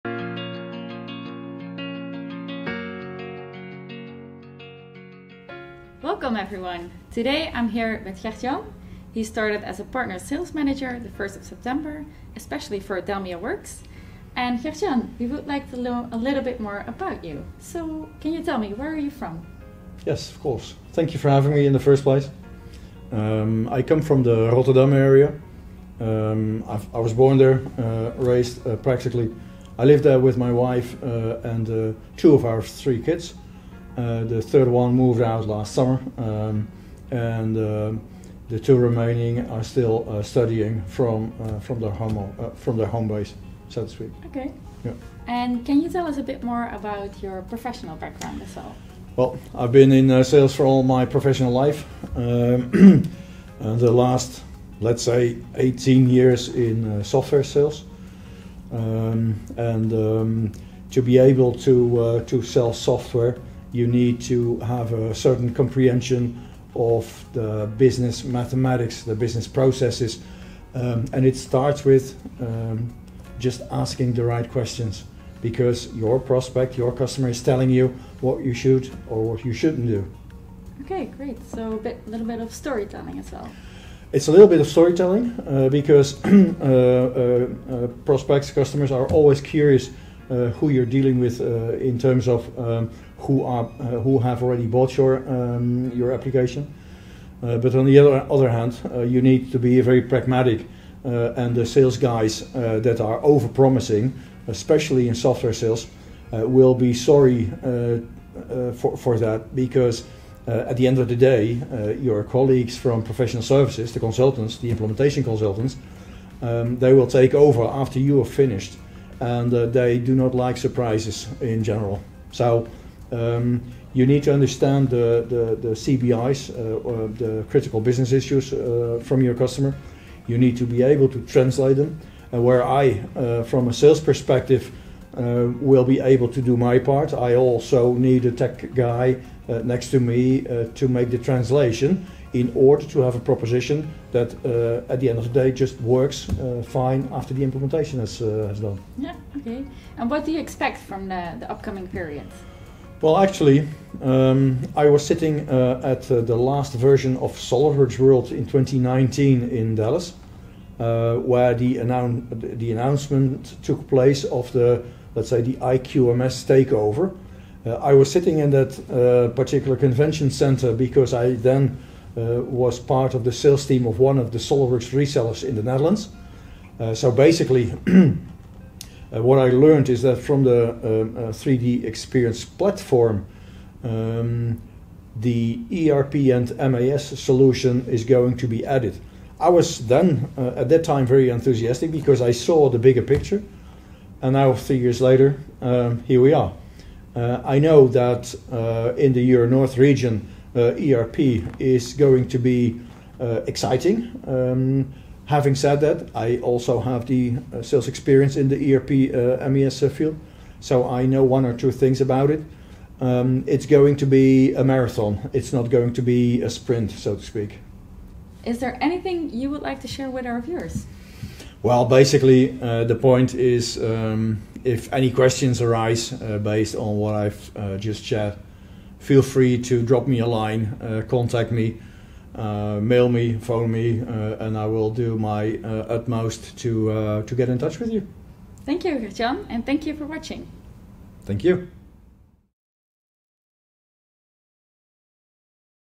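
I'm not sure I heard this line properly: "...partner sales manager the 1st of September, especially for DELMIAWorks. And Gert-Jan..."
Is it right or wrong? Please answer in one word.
right.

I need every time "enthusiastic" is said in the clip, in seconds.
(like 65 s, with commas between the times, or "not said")
191 s.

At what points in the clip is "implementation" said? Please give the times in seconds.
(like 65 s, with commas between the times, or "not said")
114 s, 147 s.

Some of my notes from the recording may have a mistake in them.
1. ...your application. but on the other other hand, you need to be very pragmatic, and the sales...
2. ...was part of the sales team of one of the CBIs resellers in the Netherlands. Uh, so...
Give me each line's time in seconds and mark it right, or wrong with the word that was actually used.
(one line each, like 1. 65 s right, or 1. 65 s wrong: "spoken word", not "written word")
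1. 95 s right
2. 172 s wrong: "SolidWorks", not "CBIs".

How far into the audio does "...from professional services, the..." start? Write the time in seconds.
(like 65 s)
112 s.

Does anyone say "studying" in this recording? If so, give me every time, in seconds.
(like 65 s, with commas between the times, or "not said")
40 s.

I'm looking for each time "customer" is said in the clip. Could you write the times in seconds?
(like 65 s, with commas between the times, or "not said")
76 s, 88 s, 129 s.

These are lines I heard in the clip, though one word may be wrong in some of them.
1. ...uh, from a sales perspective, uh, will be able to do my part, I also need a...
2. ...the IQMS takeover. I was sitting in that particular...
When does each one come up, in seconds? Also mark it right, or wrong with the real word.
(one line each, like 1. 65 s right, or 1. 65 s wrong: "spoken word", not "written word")
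1. 133 s right
2. 165 s right.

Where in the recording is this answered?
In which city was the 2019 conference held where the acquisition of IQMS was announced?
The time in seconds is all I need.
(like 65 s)
159 s.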